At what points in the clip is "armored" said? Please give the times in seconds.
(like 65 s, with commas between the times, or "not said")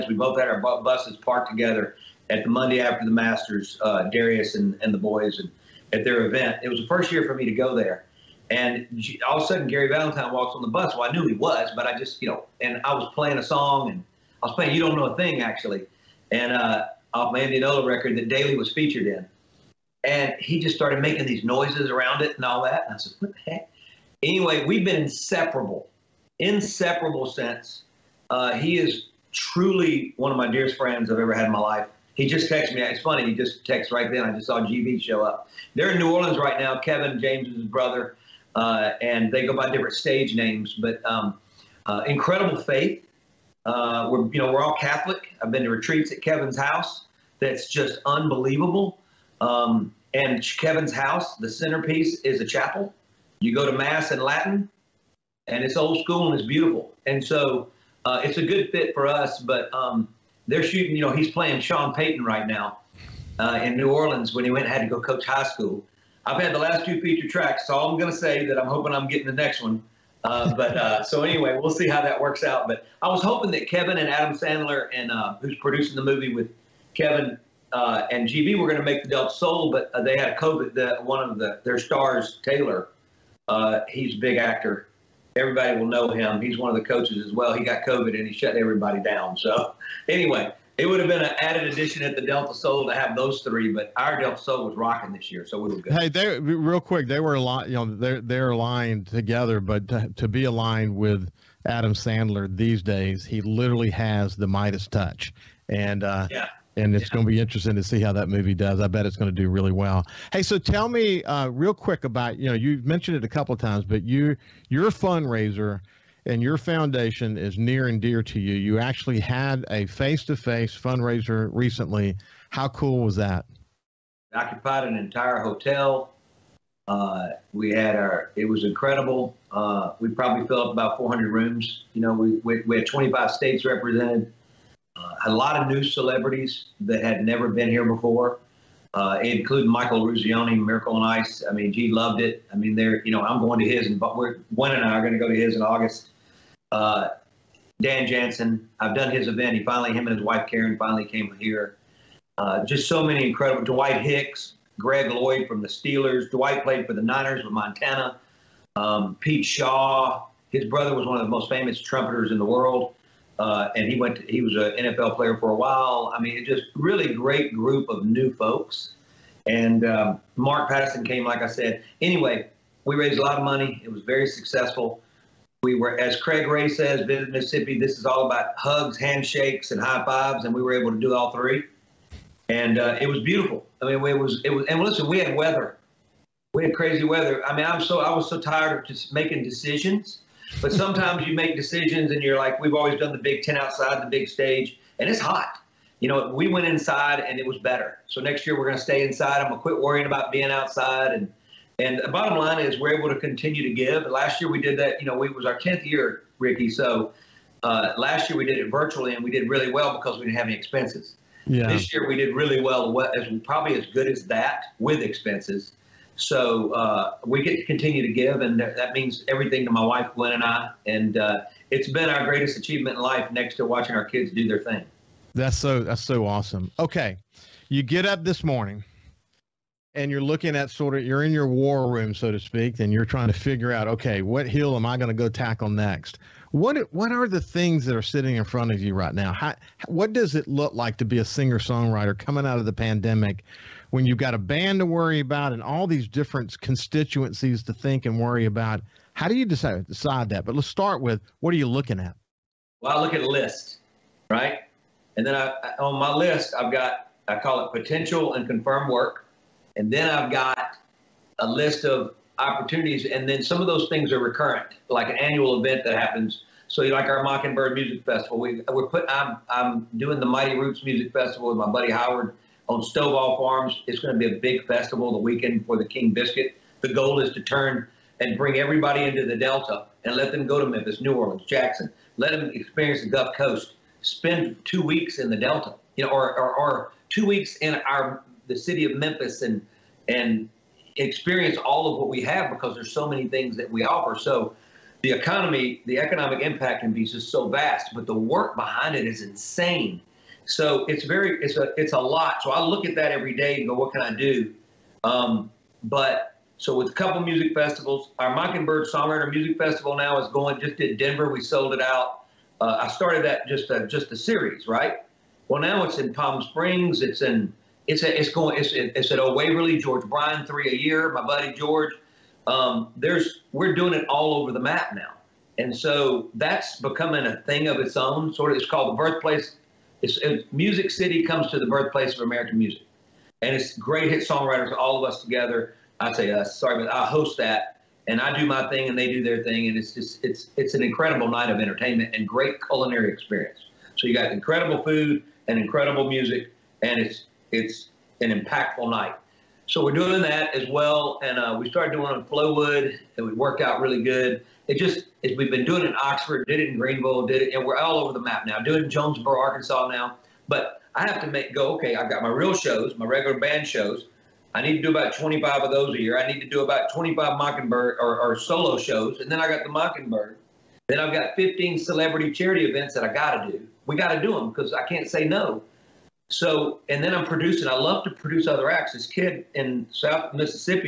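not said.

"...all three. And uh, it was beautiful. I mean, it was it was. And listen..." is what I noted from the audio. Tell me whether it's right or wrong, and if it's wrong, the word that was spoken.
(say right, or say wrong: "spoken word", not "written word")
right.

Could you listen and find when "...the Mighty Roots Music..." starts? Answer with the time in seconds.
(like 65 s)
270 s.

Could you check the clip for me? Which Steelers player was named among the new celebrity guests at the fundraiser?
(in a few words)
Greg Lloyd.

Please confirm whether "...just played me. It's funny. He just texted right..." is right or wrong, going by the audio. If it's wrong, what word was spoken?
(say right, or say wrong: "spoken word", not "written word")
wrong: "texted", not "played".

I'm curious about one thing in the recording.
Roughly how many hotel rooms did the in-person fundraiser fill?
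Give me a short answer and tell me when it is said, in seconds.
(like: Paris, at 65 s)
400, at 130 s.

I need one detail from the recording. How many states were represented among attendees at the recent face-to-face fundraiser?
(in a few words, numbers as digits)
25.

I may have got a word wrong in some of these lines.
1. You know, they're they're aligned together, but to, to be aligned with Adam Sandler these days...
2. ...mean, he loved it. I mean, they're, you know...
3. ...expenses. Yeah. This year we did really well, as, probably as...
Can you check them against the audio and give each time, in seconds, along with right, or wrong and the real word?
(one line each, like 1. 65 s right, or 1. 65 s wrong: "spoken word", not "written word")
1. 97 s right
2. 141 s right
3. 210 s right.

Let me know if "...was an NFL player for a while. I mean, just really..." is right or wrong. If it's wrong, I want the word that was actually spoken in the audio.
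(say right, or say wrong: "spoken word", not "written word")
right.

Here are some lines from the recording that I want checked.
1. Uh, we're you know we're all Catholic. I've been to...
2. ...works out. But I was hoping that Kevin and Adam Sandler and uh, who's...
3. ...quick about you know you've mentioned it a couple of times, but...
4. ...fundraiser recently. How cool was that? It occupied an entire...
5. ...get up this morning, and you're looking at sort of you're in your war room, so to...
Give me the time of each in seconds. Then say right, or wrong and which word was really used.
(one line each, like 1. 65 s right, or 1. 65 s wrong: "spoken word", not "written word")
1. 43 s right
2. 72 s right
3. 111 s right
4. 120 s right
5. 227 s right.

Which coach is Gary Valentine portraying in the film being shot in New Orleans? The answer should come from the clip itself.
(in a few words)
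Sean Payton.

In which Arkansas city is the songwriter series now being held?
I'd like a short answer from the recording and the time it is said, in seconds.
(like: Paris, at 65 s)
Jonesboro, at 358 s.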